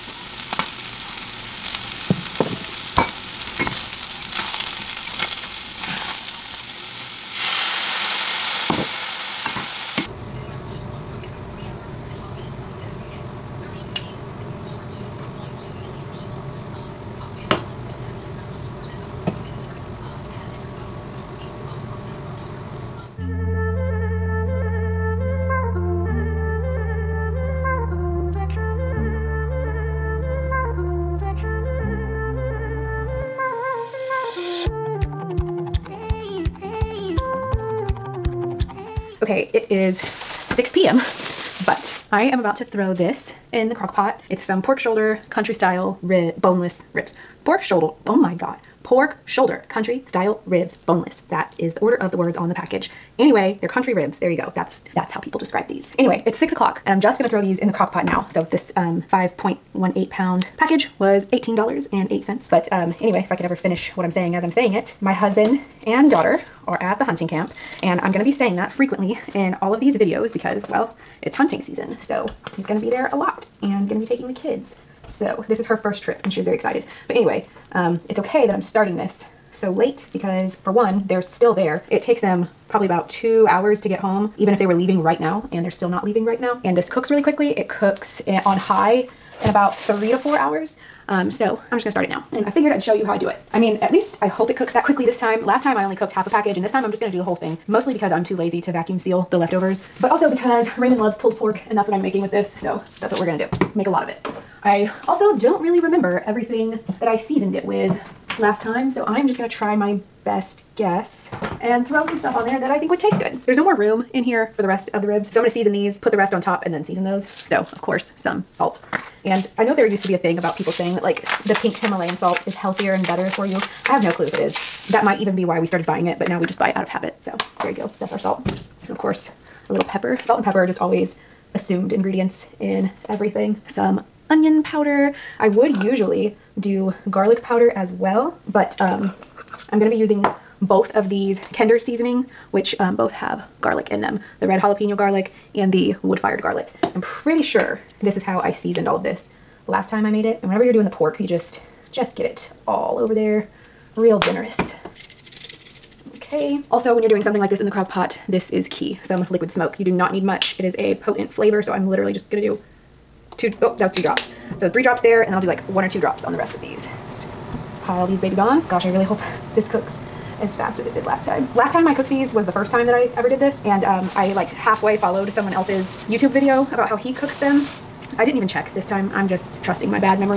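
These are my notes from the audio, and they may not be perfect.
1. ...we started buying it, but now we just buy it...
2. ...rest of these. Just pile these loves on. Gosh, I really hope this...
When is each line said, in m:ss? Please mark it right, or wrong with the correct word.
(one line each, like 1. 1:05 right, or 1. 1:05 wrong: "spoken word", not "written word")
1. 2:05 right
2. 2:46 wrong: "babies", not "loves".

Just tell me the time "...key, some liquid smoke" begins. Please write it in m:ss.
2:38.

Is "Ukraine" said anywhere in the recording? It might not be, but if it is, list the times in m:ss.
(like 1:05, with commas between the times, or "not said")
not said.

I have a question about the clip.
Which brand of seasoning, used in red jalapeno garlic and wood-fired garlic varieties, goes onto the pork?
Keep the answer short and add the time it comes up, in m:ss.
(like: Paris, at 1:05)
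Kinder, at 2:21.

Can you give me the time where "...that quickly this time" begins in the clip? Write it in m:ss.
1:34.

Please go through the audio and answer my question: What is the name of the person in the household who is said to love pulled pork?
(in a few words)
Raymond.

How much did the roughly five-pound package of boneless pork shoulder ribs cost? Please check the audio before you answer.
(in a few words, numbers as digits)
$18.08.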